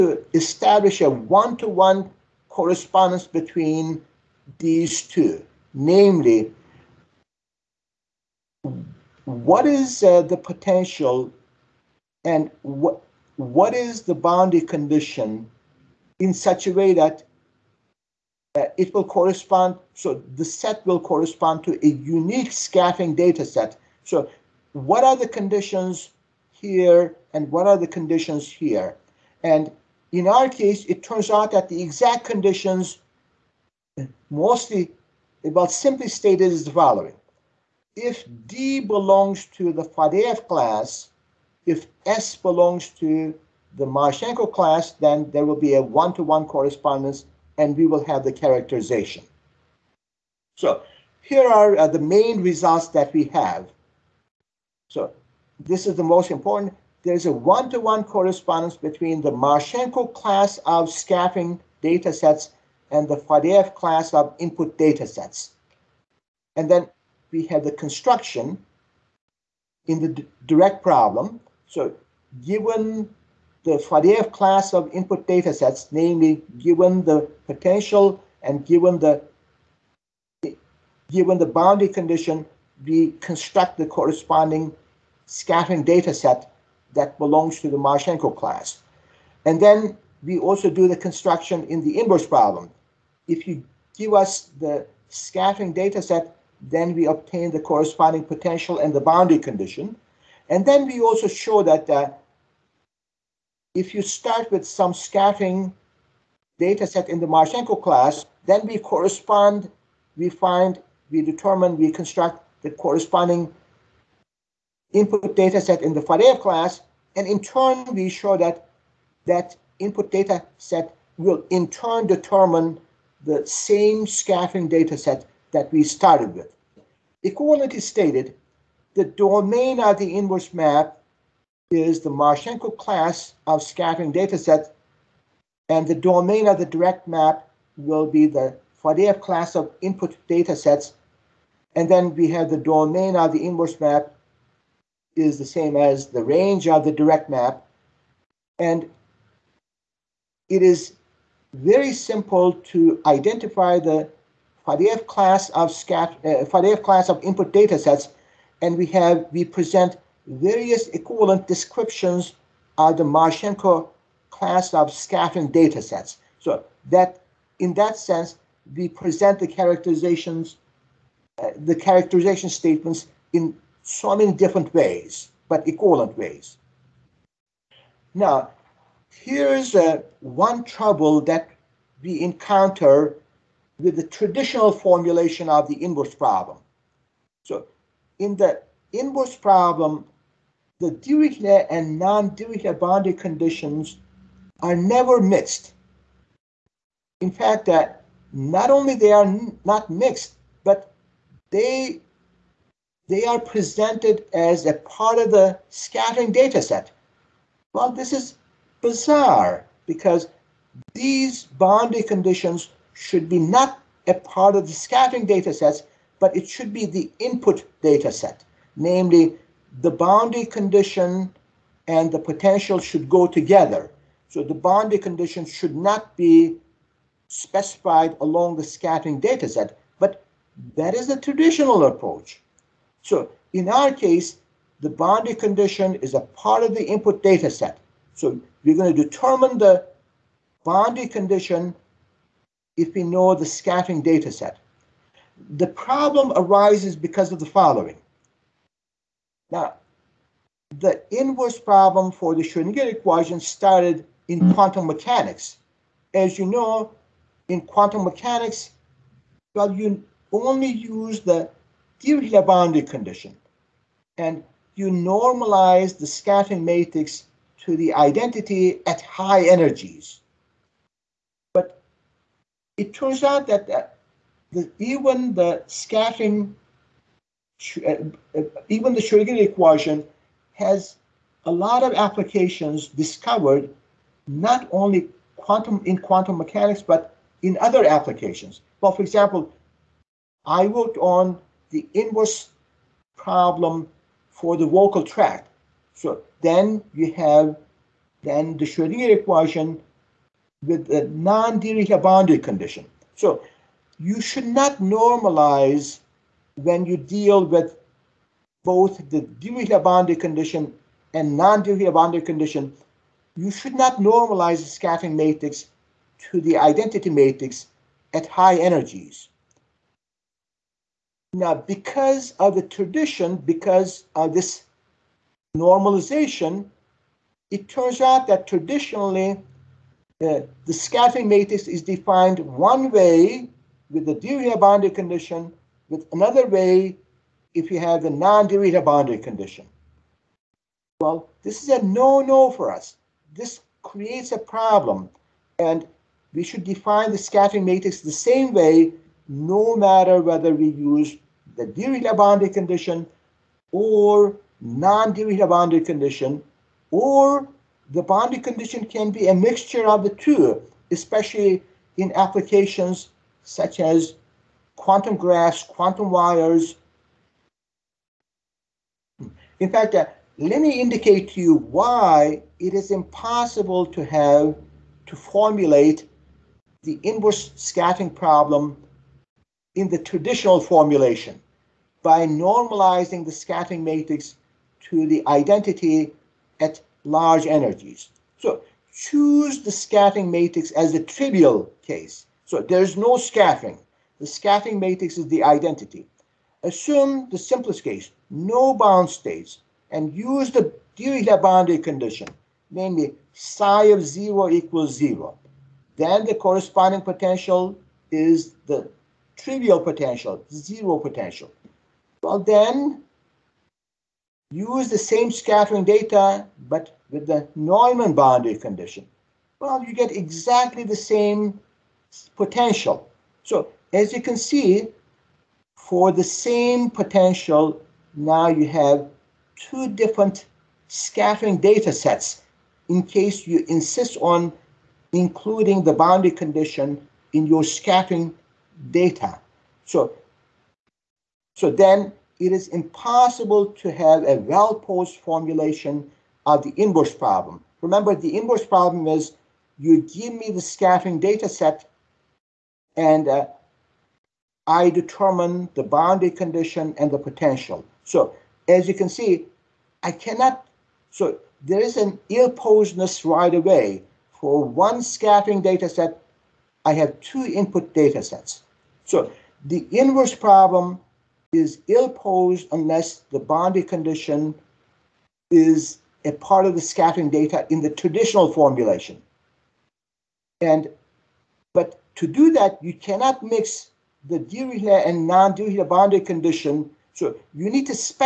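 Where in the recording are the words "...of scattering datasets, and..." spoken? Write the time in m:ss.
2:13.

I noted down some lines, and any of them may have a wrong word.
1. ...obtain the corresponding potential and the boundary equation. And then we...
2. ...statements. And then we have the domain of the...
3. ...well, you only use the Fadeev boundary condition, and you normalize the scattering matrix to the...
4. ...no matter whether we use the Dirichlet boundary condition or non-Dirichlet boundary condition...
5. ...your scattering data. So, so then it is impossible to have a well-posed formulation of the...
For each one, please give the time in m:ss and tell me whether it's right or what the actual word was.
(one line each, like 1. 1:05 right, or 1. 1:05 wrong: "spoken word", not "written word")
1. 1:37 wrong: "condition", not "equation"
2. 2:20 wrong: "datasets", not "statements"
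3. 4:19 wrong: "Dirichlet", not "Fadeev"
4. 5:49 right
5. 7:17 right.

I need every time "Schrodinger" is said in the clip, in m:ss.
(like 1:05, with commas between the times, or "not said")
4:12, 4:39, 4:58.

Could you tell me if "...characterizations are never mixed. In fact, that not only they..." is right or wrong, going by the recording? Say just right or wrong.
wrong.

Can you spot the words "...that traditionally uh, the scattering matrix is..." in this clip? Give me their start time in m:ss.
5:28.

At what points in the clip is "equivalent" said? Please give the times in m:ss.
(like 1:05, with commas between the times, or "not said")
2:07, 2:40, 2:55.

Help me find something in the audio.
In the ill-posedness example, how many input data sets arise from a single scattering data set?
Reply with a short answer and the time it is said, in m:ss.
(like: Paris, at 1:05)
2, at 7:47.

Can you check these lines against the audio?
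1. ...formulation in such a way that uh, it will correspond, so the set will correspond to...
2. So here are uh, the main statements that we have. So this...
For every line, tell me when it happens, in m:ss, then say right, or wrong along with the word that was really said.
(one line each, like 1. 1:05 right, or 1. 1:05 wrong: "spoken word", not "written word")
1. 0:14 wrong: "condition", not "formulation"
2. 0:50 wrong: "results", not "statements".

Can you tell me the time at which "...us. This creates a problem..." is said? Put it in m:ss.
5:42.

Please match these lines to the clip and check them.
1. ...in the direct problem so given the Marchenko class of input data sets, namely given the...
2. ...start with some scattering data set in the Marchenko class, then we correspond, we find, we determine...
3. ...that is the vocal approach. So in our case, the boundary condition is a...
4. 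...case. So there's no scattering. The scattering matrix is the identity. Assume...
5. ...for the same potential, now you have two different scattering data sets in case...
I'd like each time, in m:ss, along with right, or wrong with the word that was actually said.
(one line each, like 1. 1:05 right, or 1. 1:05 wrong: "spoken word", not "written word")
1. 1:09 wrong: "Fadeev", not "Marchenko"
2. 1:44 right
3. 3:50 wrong: "traditional", not "vocal"
4. 6:31 right
5. 7:05 right.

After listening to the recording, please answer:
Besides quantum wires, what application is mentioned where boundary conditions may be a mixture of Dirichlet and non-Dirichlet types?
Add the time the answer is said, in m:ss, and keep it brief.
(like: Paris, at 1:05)
quantum graphs, at 6:04.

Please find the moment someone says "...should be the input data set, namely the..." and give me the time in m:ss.
3:36.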